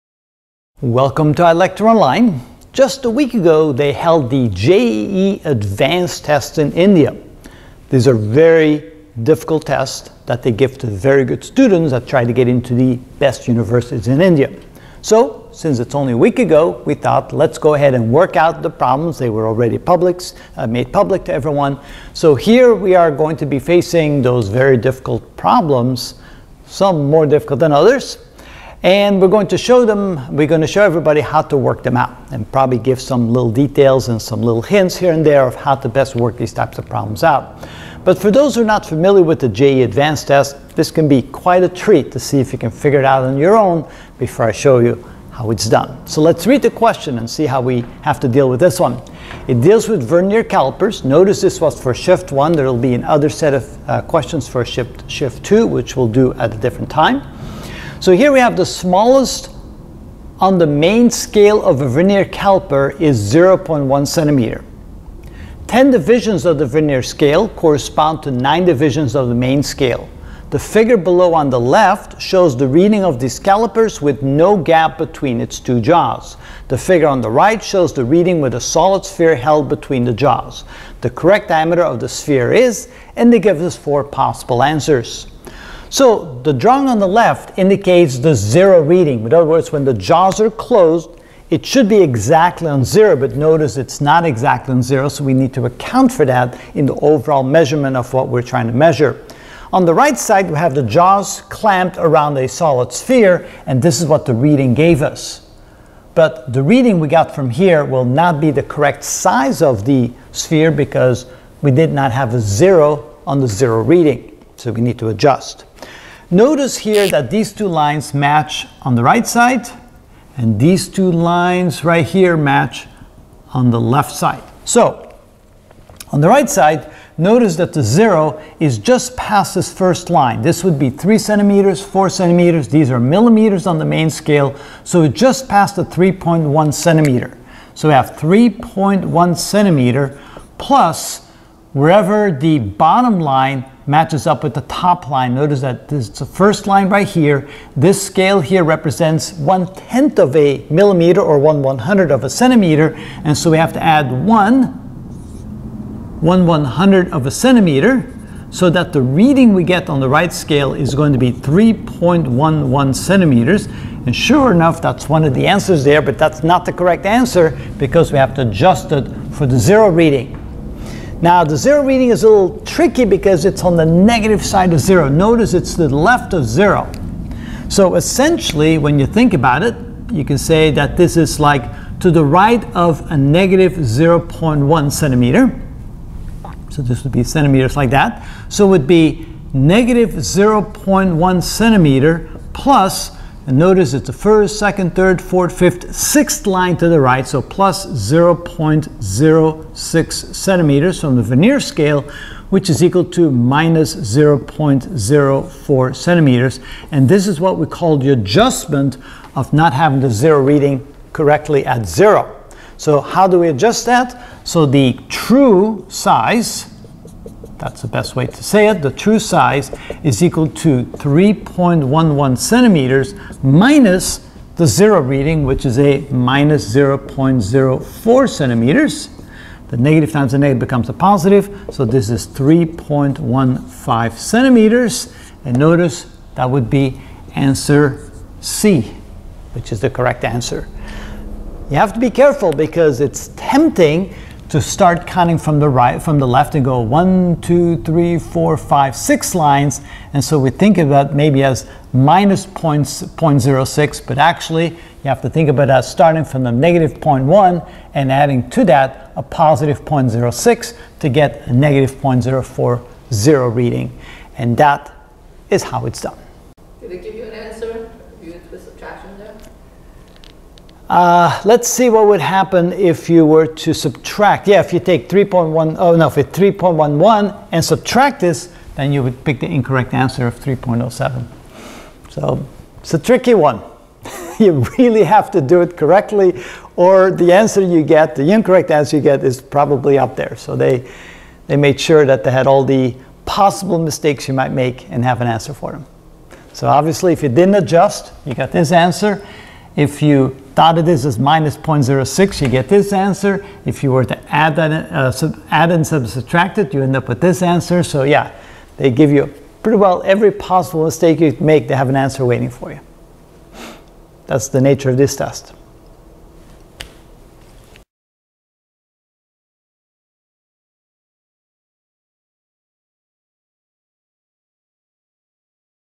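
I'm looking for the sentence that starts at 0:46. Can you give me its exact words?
So let's read the question and see how we have to deal with this one.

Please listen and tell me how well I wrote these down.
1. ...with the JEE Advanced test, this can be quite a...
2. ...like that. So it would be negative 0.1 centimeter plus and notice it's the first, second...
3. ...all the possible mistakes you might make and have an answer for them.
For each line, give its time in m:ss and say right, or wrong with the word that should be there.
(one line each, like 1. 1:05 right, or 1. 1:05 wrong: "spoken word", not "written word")
1. 0:39 right
2. 3:07 right
3. 4:52 right.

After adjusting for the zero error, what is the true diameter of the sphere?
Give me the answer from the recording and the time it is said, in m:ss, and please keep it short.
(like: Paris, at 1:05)
3.15 centimeters, at 3:52.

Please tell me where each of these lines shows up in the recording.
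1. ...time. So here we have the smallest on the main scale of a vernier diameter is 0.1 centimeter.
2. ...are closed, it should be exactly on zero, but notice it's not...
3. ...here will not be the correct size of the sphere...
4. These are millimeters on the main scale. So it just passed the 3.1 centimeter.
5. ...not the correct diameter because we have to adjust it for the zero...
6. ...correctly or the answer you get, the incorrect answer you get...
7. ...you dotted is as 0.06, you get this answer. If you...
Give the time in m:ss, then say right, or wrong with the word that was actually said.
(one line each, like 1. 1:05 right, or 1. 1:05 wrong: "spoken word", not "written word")
1. 0:56 wrong: "caliper", not "diameter"
2. 1:30 right
3. 1:47 right
4. 2:12 right
5. 2:46 wrong: "answer", not "diameter"
6. 4:45 right
7. 5:00 right.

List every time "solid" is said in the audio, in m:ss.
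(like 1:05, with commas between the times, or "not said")
1:18, 1:42.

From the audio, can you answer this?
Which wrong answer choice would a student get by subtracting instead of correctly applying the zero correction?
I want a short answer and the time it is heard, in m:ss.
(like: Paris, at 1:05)
3.07, at 4:40.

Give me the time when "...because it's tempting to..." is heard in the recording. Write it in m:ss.
4:02.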